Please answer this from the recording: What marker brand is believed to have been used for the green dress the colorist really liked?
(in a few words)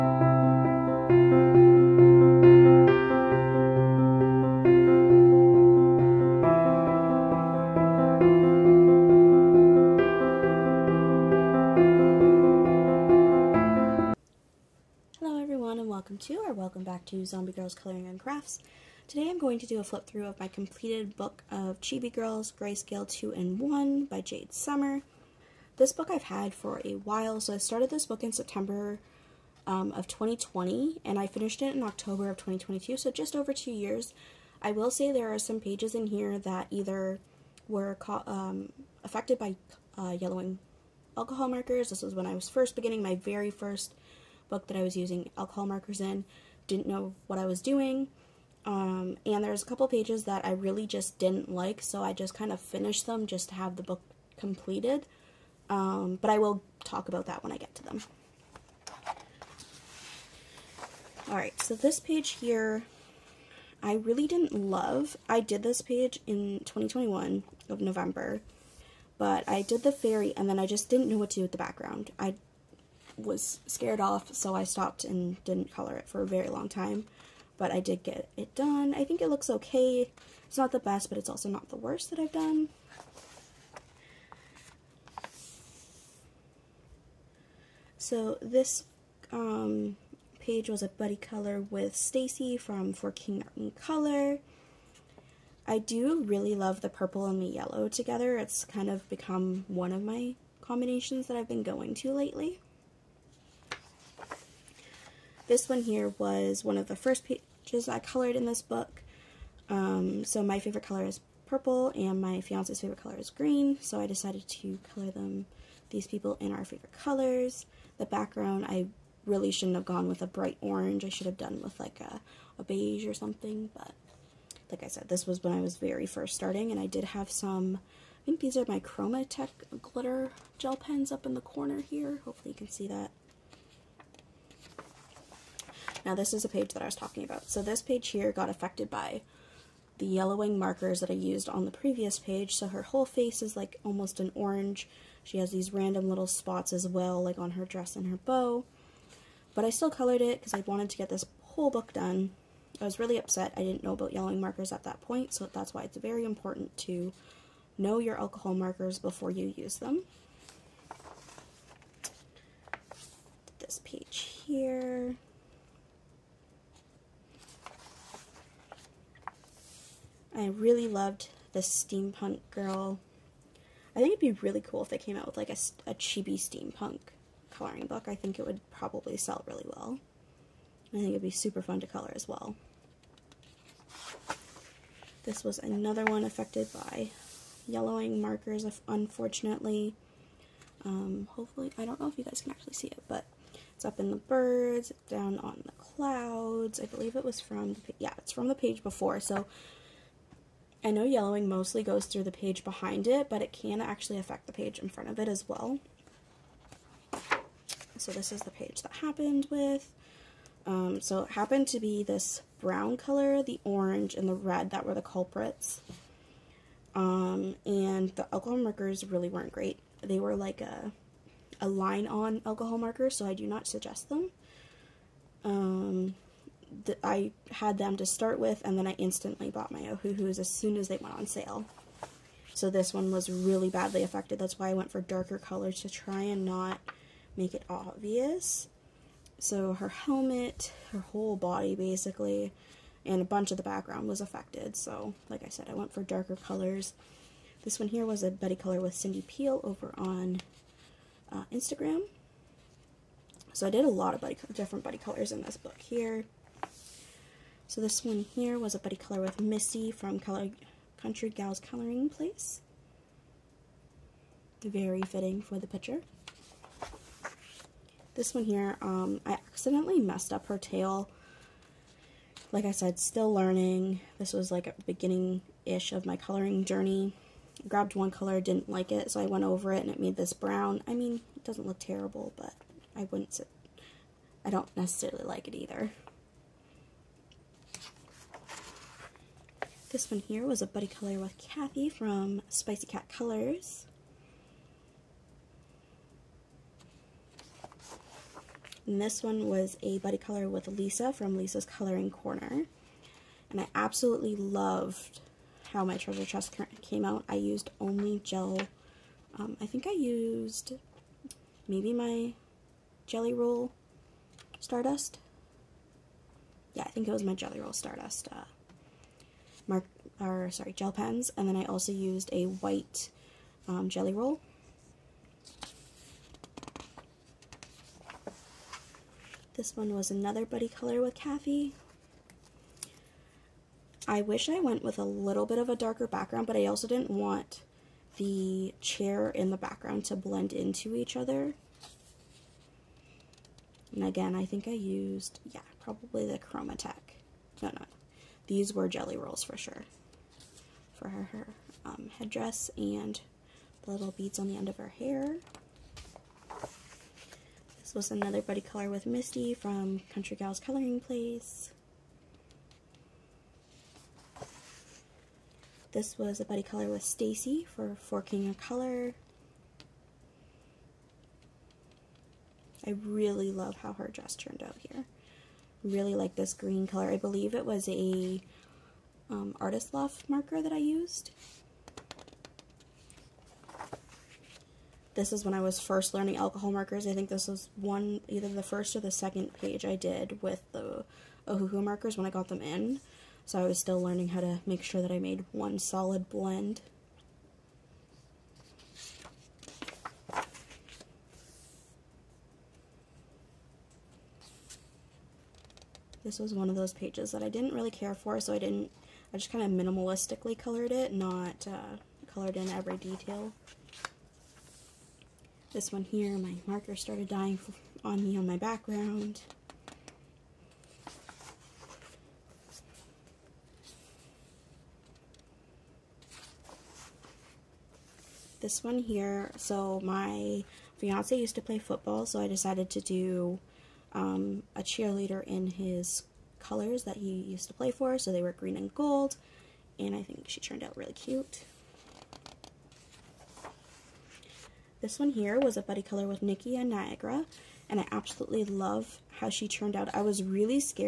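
Artist Loft.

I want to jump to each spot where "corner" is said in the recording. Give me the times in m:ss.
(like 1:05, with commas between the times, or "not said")
2:11, 5:02.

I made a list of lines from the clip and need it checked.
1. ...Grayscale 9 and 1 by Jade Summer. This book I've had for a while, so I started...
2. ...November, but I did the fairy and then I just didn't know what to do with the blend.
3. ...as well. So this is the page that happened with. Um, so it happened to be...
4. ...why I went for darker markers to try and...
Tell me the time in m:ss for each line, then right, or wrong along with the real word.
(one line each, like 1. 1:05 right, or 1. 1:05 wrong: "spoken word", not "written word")
1. 0:22 wrong: "2", not "9"
2. 1:07 wrong: "background", not "blend"
3. 3:25 right
4. 3:54 wrong: "colors", not "markers".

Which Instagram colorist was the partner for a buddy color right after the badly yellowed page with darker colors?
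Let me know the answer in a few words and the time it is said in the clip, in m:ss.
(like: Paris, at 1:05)
Cindy Peel, at 4:08.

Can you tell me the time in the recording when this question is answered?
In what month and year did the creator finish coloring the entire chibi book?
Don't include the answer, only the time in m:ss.
0:31.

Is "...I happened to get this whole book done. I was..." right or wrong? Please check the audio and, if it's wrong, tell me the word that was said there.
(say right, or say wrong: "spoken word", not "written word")
wrong: "wanted", not "happened".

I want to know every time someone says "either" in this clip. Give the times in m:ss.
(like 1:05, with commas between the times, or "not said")
0:36, 4:45, 6:28.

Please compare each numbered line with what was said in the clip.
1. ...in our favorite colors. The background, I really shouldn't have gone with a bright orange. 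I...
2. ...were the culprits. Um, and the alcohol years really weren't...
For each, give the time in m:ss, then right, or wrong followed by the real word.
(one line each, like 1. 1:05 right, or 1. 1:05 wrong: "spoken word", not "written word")
1. 1:56 right
2. 3:34 wrong: "markers", not "years".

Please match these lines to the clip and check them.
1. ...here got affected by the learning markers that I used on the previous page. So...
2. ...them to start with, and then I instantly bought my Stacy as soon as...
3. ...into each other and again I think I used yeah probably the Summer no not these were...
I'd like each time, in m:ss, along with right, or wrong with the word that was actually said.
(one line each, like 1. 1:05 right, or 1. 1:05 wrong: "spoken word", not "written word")
1. 2:18 wrong: "yellowing", not "learning"
2. 3:47 wrong: "Ohuhus", not "Stacy"
3. 5:40 wrong: "Chromatech", not "Summer".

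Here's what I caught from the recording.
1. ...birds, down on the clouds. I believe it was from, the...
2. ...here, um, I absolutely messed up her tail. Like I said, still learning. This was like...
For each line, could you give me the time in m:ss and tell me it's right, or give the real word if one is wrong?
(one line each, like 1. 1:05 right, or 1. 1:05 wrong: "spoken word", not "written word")
1. 3:14 right
2. 4:28 wrong: "accidentally", not "absolutely".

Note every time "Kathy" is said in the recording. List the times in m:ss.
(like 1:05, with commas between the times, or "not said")
4:51, 5:31.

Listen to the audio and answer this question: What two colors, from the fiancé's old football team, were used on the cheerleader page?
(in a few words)
Green and gold.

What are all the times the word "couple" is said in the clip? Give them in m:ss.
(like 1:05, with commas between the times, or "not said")
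0:49.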